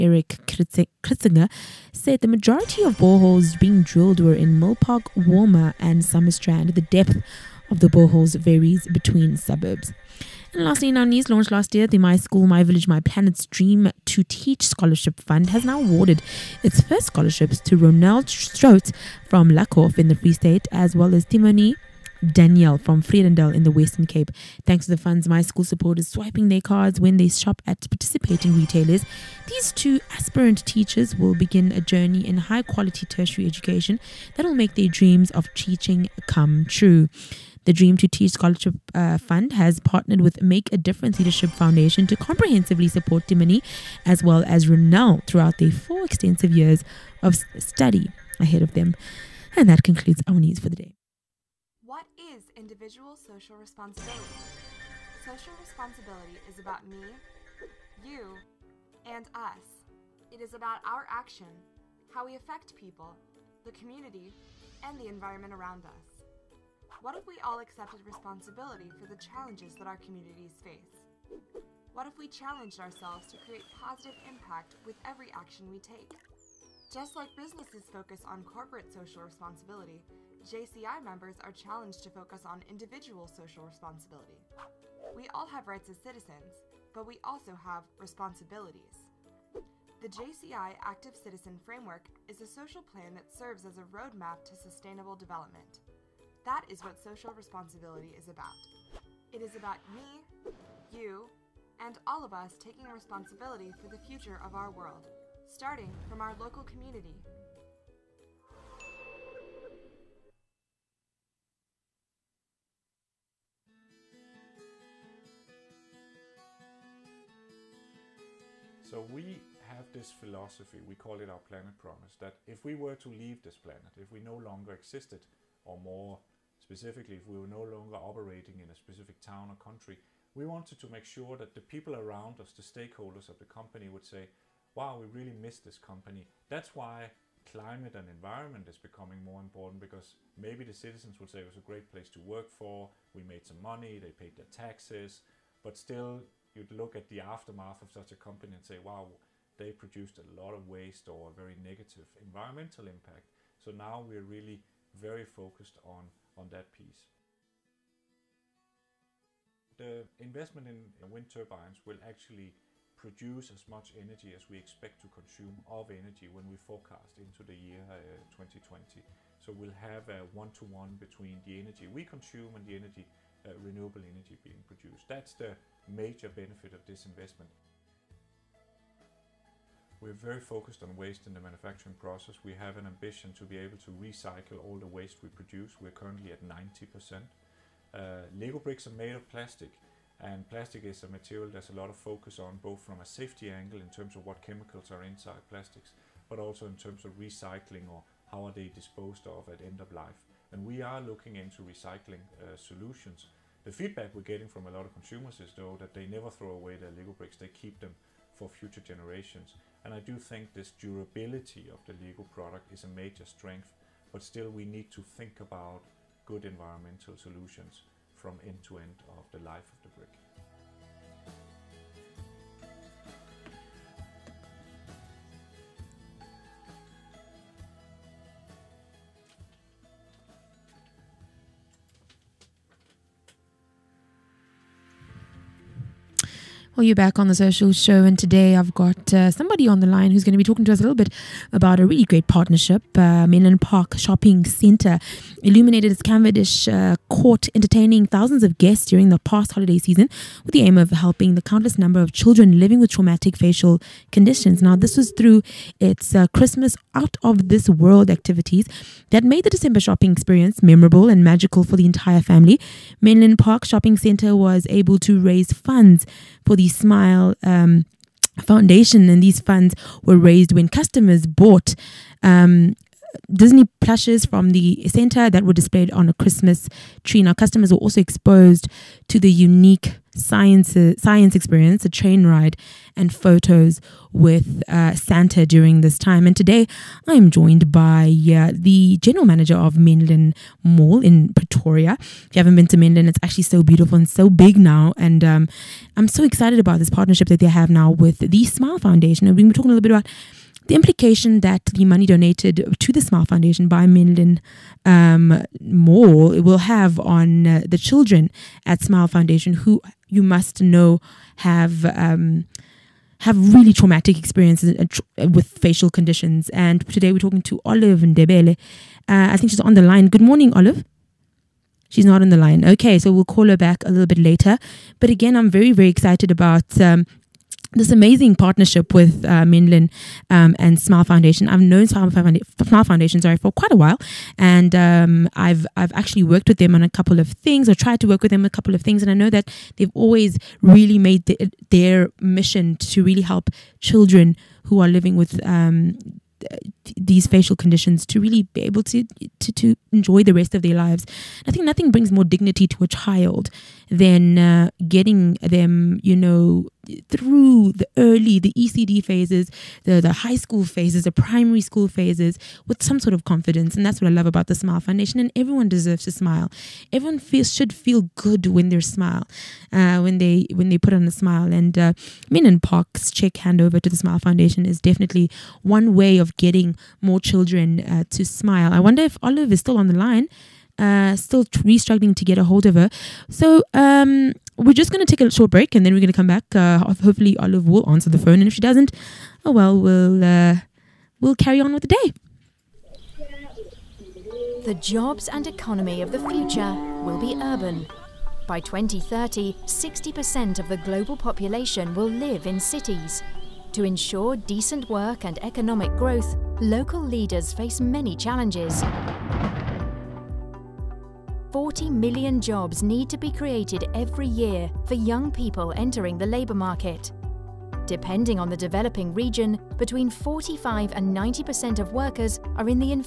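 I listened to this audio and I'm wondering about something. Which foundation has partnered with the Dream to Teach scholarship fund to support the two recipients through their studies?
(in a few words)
Make a Difference Leadership Foundation.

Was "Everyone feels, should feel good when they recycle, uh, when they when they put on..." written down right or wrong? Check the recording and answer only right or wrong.
wrong.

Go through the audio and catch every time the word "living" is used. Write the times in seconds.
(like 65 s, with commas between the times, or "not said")
252 s, 344 s.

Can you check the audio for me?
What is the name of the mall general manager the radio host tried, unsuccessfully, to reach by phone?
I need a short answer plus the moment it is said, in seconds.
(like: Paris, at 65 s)
Olive Ndebele, at 317 s.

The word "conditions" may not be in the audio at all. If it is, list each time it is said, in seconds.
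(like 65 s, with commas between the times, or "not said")
254 s, 315 s, 347 s.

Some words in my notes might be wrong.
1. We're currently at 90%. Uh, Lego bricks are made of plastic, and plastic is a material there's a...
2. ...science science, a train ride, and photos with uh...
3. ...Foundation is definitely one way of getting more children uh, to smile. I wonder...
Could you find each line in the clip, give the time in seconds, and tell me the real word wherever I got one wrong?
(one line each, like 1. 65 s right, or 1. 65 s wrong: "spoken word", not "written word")
1. 185 s right
2. 281 s wrong: "experience", not "science"
3. 374 s right.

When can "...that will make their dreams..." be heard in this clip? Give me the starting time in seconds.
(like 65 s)
34 s.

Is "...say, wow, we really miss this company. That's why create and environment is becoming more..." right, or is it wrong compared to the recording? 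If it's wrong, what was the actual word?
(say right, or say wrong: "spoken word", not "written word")
wrong: "climate", not "create".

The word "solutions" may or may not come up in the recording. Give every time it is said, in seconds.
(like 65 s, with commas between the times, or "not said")
202 s, 217 s.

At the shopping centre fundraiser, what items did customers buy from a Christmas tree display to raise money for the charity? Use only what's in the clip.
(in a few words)
Disney plushes.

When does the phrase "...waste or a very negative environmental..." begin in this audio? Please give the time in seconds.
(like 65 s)
150 s.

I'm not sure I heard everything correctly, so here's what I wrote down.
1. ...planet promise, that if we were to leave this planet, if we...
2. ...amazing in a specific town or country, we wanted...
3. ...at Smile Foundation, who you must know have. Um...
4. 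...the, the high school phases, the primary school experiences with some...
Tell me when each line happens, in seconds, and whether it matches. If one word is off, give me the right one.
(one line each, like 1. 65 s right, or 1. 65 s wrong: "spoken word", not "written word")
1. 121 s right
2. 127 s wrong: "operating", not "amazing"
3. 308 s right
4. 359 s wrong: "phases", not "experiences".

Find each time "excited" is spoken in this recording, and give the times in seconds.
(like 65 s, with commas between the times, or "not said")
296 s, 325 s.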